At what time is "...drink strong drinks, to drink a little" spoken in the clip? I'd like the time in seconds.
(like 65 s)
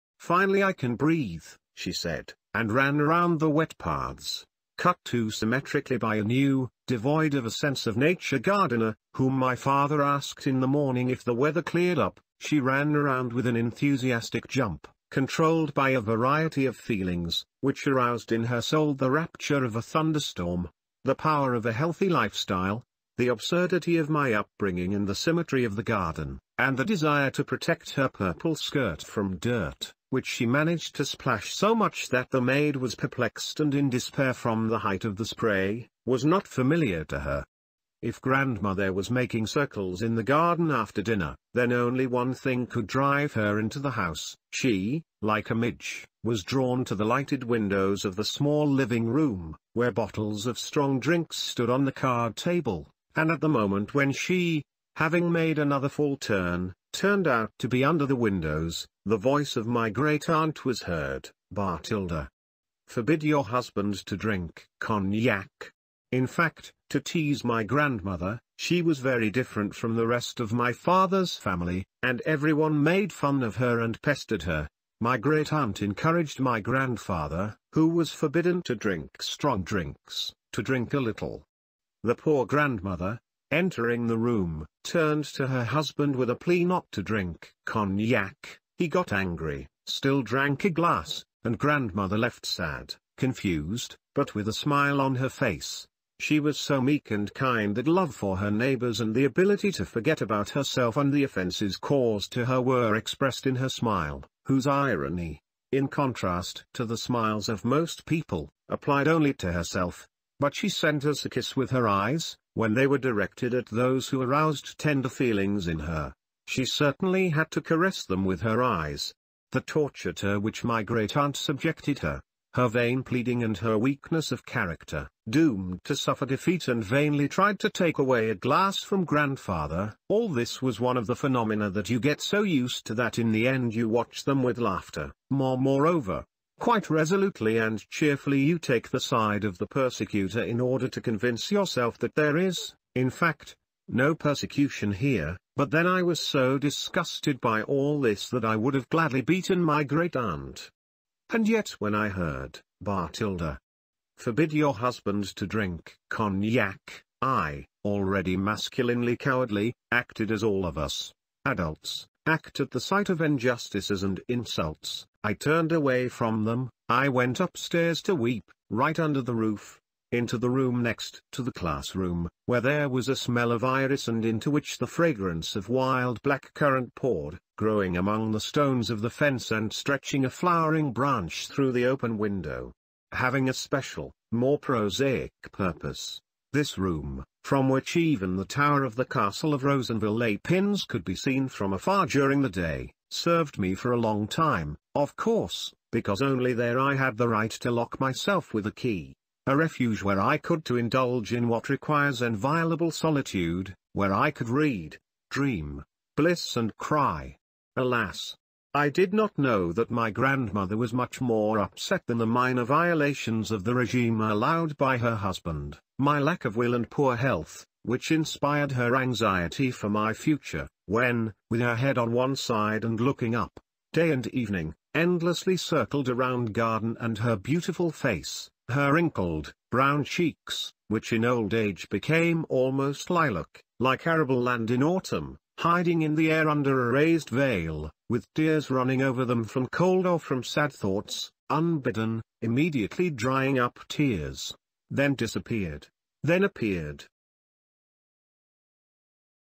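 78 s.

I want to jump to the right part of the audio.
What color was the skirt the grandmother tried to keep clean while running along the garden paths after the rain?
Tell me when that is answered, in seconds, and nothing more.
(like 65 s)
28 s.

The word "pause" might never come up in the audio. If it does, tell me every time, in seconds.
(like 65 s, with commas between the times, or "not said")
not said.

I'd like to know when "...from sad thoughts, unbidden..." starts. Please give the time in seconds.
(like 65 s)
240 s.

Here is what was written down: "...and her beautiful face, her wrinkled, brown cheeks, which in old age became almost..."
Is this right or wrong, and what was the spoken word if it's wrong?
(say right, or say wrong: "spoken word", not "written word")
right.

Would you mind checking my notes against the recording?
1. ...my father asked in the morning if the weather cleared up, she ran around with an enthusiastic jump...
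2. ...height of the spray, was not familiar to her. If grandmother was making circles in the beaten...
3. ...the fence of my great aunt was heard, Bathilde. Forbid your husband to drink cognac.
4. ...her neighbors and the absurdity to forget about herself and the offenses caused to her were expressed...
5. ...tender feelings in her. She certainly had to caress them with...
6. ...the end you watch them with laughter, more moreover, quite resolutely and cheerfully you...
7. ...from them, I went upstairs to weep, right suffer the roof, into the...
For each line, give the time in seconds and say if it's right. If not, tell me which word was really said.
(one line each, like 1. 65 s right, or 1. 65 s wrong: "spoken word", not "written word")
1. 9 s right
2. 34 s wrong: "garden", not "beaten"
3. 59 s wrong: "voice", not "fence"
4. 98 s wrong: "ability", not "absurdity"
5. 114 s right
6. 133 s right
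7. 166 s wrong: "under", not "suffer".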